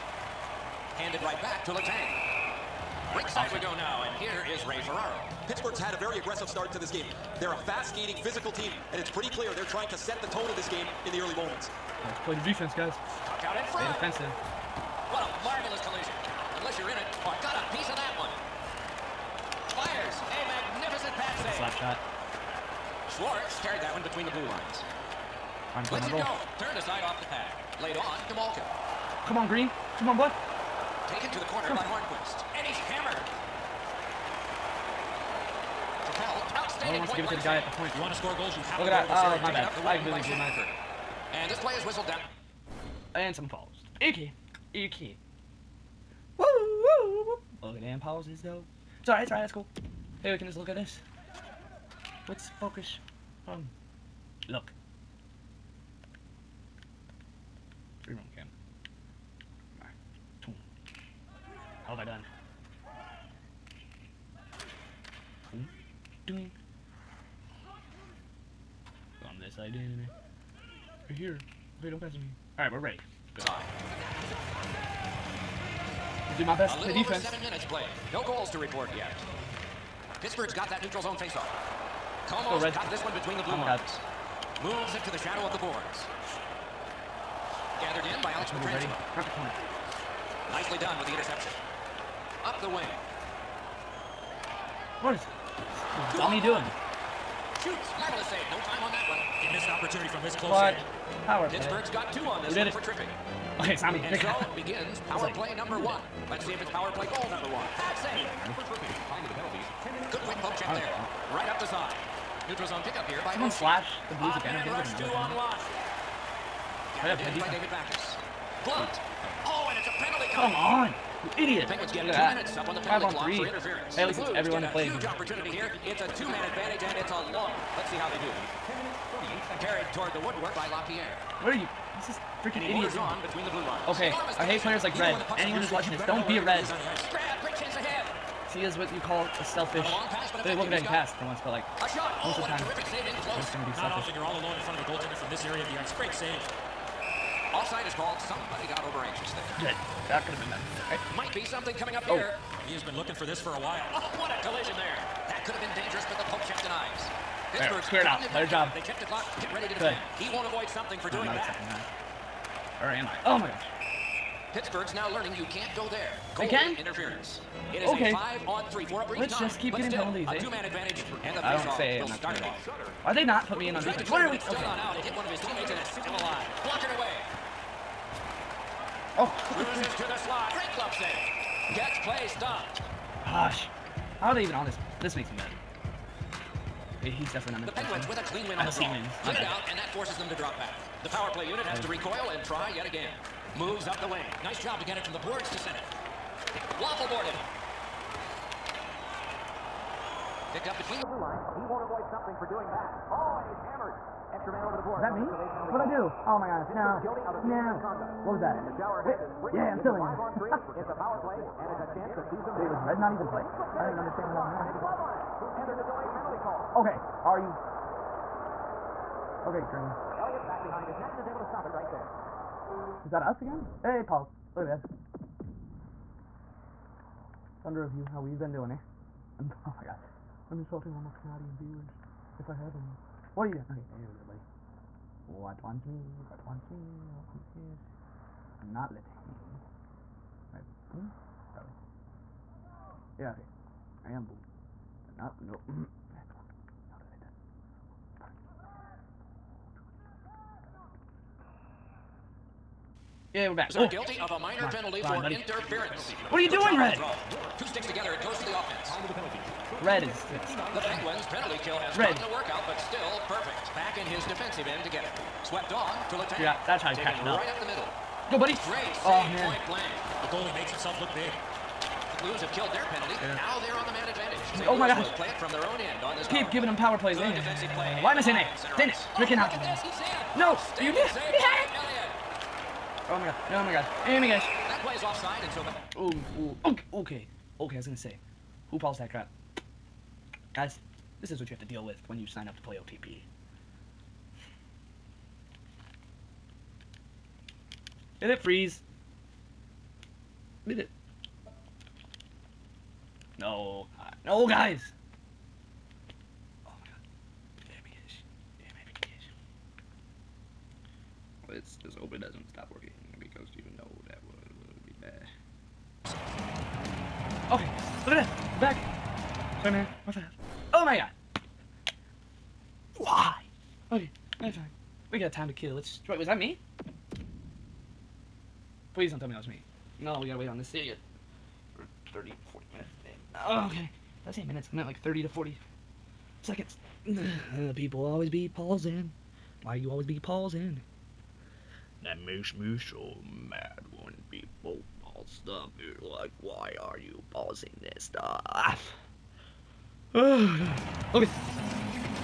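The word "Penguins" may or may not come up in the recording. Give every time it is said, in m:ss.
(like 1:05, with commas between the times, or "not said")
2:01, 3:07, 4:20.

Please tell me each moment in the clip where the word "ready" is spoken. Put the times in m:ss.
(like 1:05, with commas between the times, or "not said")
1:12, 2:39.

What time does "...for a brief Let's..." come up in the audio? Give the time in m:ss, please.
2:48.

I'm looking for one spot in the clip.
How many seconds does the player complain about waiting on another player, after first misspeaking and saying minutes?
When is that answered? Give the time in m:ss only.
5:35.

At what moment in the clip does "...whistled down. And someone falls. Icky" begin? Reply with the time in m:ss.
0:41.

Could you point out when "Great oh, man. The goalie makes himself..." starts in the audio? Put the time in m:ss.
4:28.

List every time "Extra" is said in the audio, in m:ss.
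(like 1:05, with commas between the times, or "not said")
3:24.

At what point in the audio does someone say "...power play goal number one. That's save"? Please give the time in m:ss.
1:46.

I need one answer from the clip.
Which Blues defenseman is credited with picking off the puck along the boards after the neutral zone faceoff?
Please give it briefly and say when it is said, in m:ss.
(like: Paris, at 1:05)
Alex Pietrangelo, at 1:28.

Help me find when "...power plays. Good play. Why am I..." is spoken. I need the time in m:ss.
4:36.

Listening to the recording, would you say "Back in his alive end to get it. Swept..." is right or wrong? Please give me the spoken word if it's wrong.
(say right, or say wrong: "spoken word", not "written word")
wrong: "defensive", not "alive".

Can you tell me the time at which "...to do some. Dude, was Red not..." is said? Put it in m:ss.
3:32.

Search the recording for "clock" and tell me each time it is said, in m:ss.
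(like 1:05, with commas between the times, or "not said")
2:03, 2:39.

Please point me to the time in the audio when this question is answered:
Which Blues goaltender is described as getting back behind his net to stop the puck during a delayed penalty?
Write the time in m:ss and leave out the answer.
3:40.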